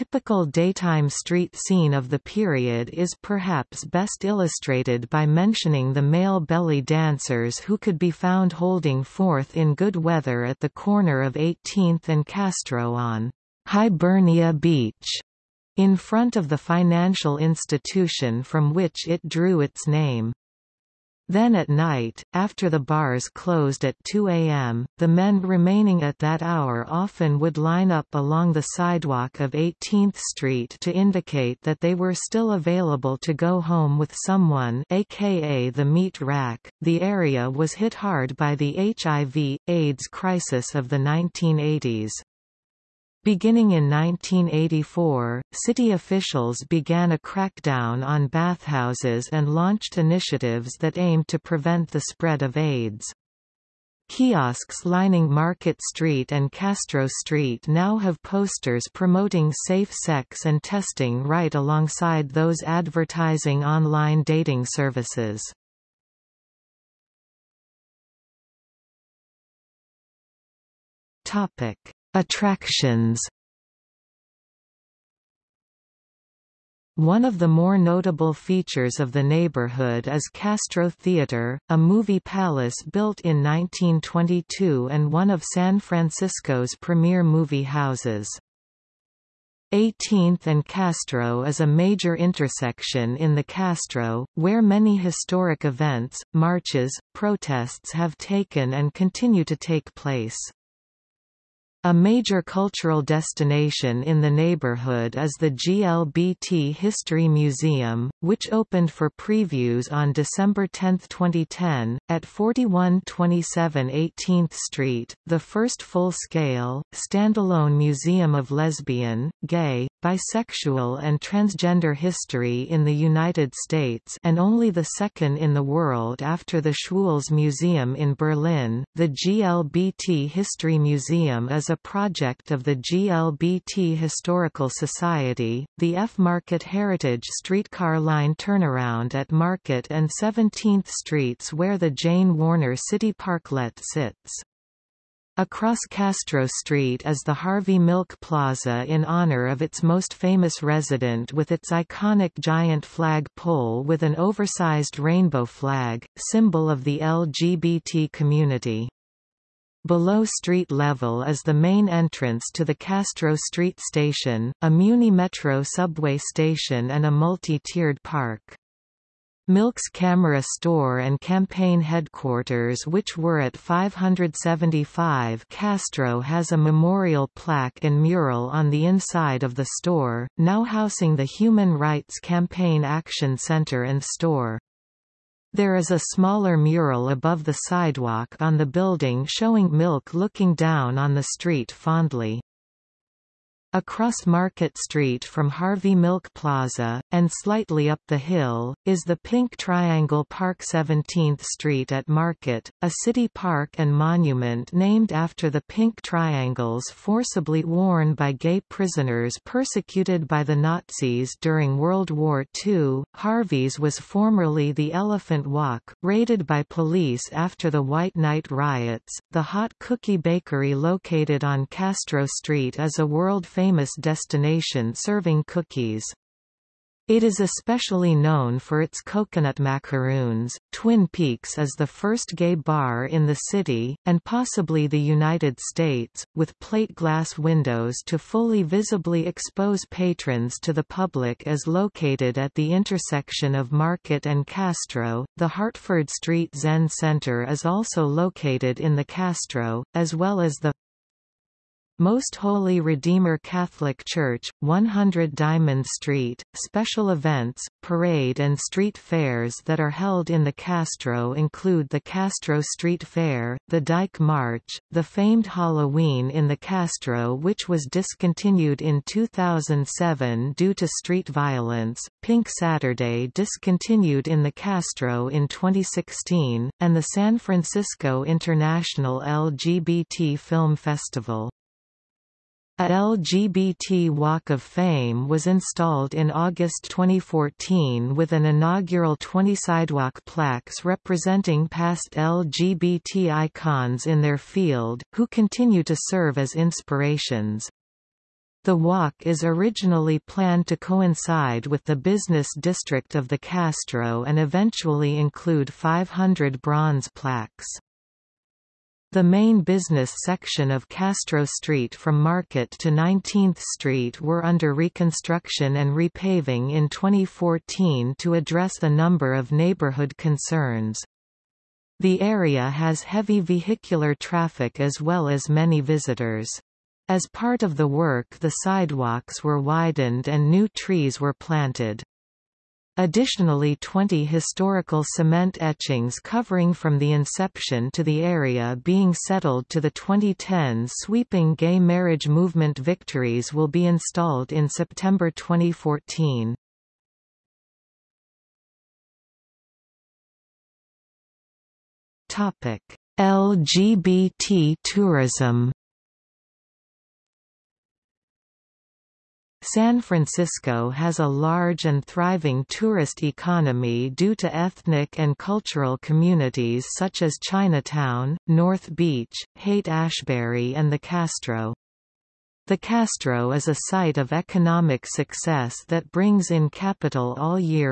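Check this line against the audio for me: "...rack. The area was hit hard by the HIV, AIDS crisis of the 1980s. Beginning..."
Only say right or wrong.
right.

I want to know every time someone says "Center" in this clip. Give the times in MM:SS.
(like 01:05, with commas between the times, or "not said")
03:03, 04:06.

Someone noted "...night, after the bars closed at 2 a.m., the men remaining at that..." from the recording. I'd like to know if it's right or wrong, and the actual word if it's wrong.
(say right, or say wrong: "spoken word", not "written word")
right.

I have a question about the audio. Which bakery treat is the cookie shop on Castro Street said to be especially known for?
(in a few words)
coconut macaroons.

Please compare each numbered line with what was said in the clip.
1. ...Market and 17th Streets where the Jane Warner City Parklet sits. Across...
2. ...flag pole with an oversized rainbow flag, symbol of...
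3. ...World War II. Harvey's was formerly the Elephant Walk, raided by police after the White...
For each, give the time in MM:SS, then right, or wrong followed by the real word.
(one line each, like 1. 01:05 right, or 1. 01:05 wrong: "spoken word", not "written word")
1. 02:19 right
2. 02:32 right
3. 03:31 right.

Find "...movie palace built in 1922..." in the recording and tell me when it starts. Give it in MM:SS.
01:21.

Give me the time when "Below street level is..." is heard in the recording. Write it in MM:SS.
02:39.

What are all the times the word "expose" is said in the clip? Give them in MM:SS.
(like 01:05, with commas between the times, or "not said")
03:59.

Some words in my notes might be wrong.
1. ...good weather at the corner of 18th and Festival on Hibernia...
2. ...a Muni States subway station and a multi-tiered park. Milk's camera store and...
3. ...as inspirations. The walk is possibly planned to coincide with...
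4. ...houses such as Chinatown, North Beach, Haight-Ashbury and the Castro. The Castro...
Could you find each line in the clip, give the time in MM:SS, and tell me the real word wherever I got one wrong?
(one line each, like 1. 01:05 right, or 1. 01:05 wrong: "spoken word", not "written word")
1. 00:09 wrong: "Castro", not "Festival"
2. 02:44 wrong: "Metro", not "States"
3. 04:56 wrong: "originally", not "possibly"
4. 06:05 wrong: "communities", not "houses".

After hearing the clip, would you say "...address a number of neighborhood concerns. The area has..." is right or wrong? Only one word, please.
right.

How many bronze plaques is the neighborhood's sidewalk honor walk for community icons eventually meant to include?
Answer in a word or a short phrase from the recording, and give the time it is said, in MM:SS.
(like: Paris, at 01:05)
500, at 05:05.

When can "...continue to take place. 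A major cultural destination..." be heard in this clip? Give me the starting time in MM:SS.
01:38.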